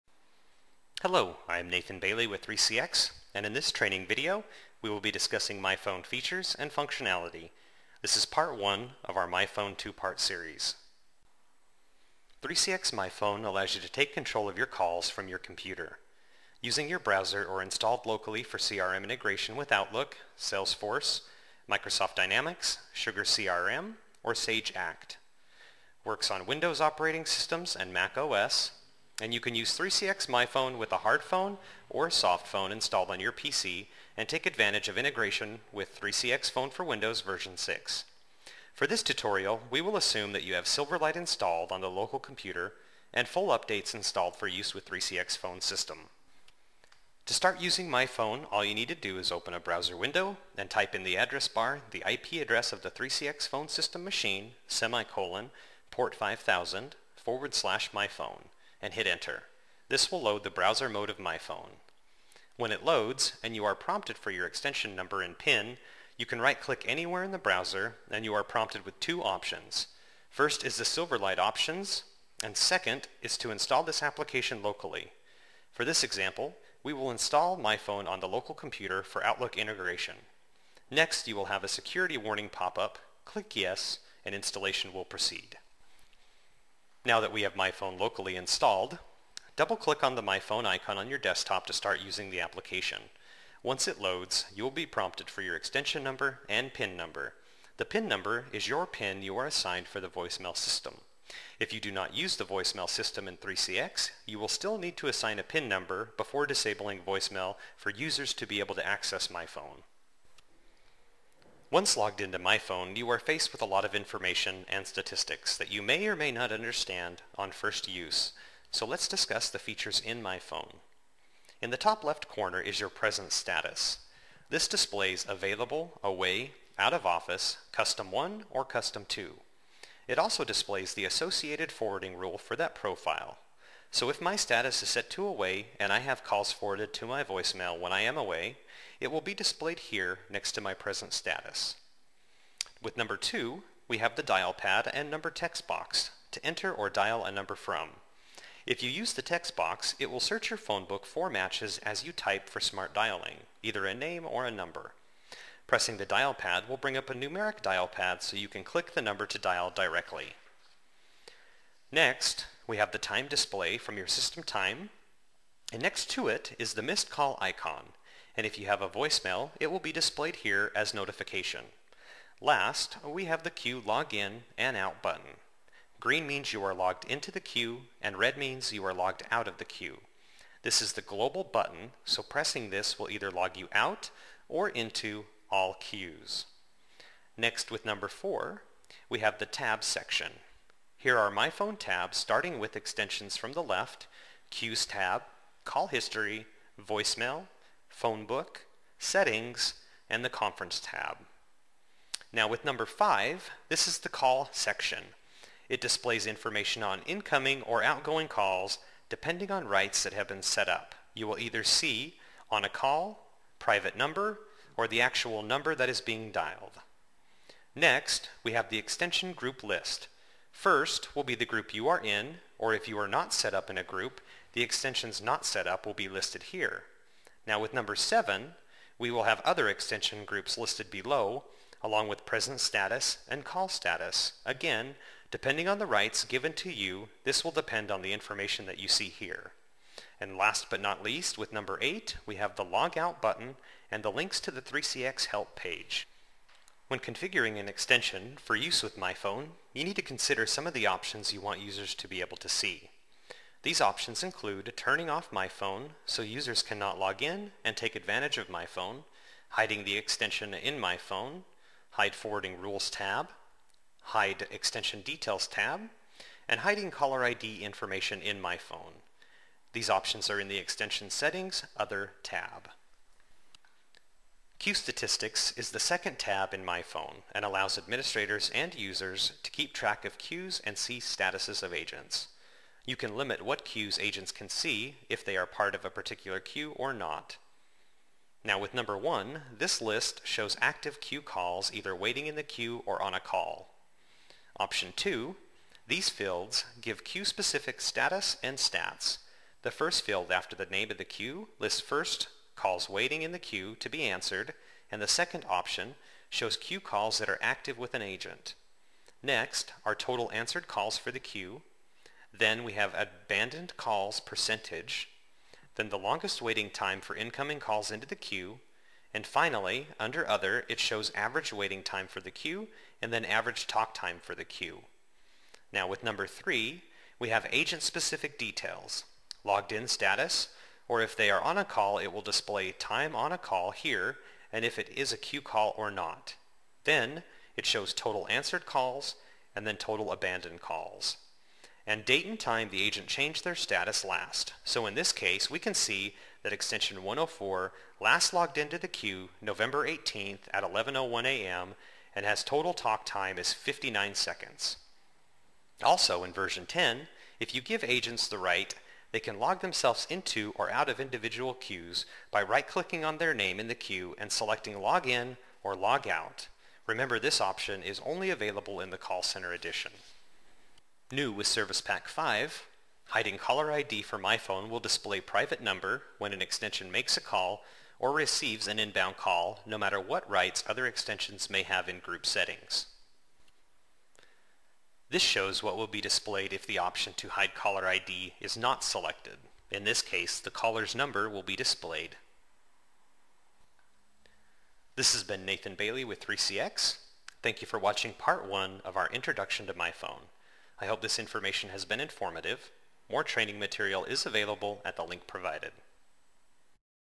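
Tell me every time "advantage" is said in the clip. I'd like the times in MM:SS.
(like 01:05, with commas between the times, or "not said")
00:34, 04:17.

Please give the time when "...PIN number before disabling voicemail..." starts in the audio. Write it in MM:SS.
01:45.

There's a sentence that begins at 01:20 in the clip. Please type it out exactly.
Next, you will have a security warning pop-up, click yes, and installation will proceed.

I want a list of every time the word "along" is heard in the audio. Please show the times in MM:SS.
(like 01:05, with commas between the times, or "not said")
03:51.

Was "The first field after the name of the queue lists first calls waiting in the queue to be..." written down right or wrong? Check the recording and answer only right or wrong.
right.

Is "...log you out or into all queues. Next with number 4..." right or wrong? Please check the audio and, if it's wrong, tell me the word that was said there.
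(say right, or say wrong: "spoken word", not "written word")
right.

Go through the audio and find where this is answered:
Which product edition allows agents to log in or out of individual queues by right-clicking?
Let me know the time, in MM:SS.
06:08.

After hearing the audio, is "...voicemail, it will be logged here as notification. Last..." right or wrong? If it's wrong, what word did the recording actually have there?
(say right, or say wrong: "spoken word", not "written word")
wrong: "displayed", not "logged".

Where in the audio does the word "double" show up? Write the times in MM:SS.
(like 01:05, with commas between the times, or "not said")
01:29.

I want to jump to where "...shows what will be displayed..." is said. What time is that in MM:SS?
06:25.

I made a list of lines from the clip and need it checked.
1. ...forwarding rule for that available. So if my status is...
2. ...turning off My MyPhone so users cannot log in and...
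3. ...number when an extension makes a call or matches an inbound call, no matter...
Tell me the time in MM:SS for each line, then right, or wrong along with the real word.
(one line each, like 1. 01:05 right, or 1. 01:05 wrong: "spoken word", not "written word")
1. 02:11 wrong: "profile", not "available"
2. 04:14 wrong: "Phone", not "MyPhone"
3. 06:15 wrong: "receives", not "matches".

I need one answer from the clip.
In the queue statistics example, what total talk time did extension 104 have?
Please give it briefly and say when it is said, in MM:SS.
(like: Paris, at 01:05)
59 seconds, at 05:53.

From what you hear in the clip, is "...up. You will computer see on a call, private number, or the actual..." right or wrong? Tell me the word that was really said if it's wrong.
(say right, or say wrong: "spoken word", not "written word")
wrong: "either", not "computer".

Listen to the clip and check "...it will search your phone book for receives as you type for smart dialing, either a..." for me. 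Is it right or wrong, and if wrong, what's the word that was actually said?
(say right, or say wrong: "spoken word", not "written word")
wrong: "matches", not "receives".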